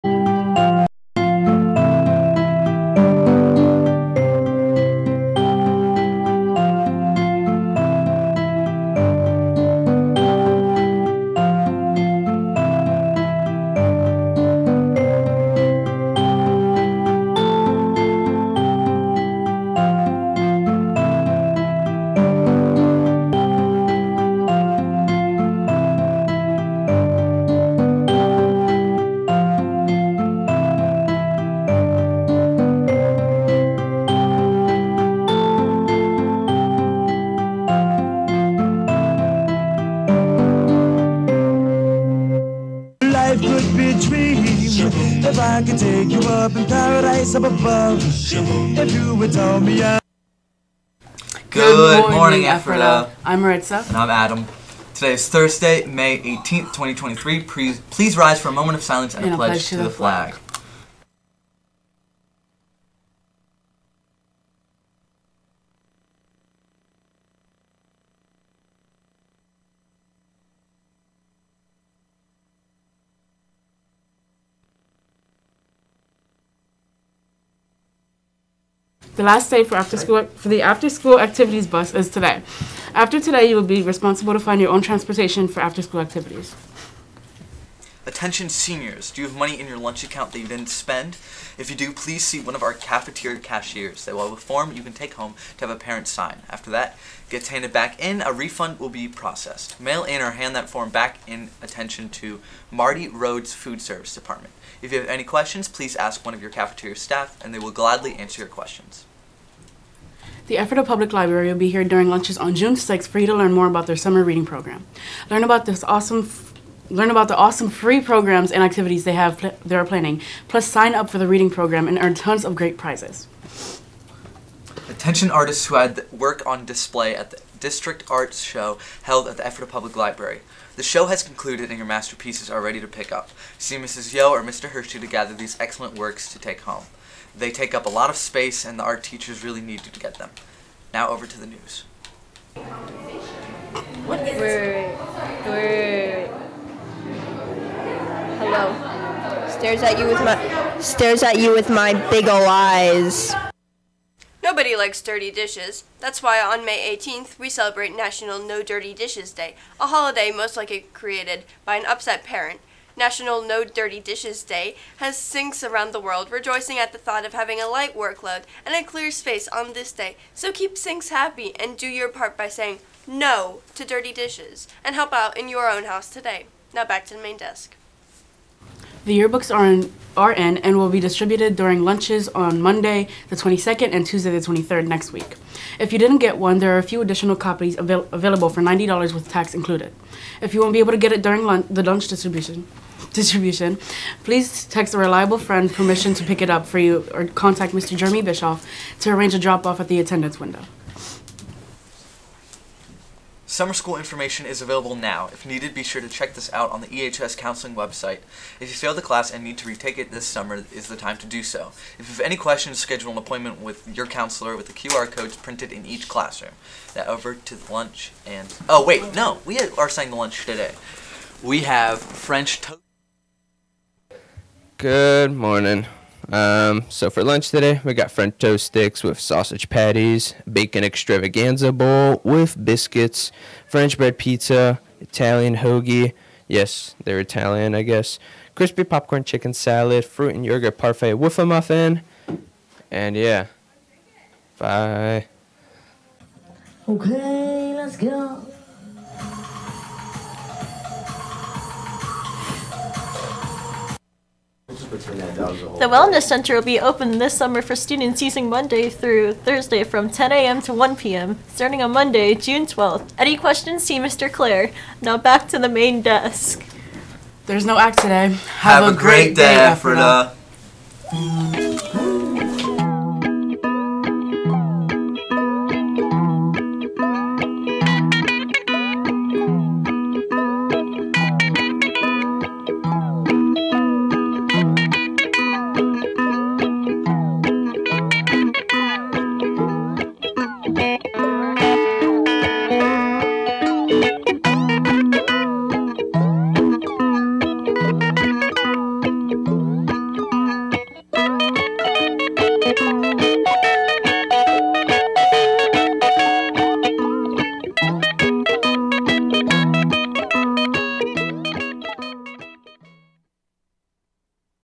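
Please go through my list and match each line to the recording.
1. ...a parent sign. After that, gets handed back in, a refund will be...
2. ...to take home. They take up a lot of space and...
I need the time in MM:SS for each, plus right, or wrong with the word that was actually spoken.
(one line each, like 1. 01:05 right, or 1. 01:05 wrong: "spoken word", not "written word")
1. 01:35 right
2. 02:16 right.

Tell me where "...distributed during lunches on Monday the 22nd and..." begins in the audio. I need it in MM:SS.
03:00.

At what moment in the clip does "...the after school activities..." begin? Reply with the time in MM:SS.
01:20.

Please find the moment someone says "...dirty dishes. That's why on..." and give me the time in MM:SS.
02:35.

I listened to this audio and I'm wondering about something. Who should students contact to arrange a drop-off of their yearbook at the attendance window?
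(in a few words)
Jeremy Bischoff.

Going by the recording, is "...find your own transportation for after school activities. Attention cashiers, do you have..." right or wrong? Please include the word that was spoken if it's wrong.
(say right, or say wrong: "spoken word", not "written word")
wrong: "seniors", not "cashiers".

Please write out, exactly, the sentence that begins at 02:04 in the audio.
Attention artists who had work on display at the District Arts Show held at the Ephrata Public Library.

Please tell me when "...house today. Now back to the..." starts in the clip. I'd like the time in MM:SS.
02:55.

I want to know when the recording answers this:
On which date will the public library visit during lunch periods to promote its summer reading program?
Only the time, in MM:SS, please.
01:52.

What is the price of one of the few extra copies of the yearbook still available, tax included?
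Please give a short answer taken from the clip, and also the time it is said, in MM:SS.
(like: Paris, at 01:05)
$90, at 03:08.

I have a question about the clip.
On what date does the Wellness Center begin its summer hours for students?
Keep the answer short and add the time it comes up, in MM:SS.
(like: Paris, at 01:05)
Monday, June 12th, at 04:21.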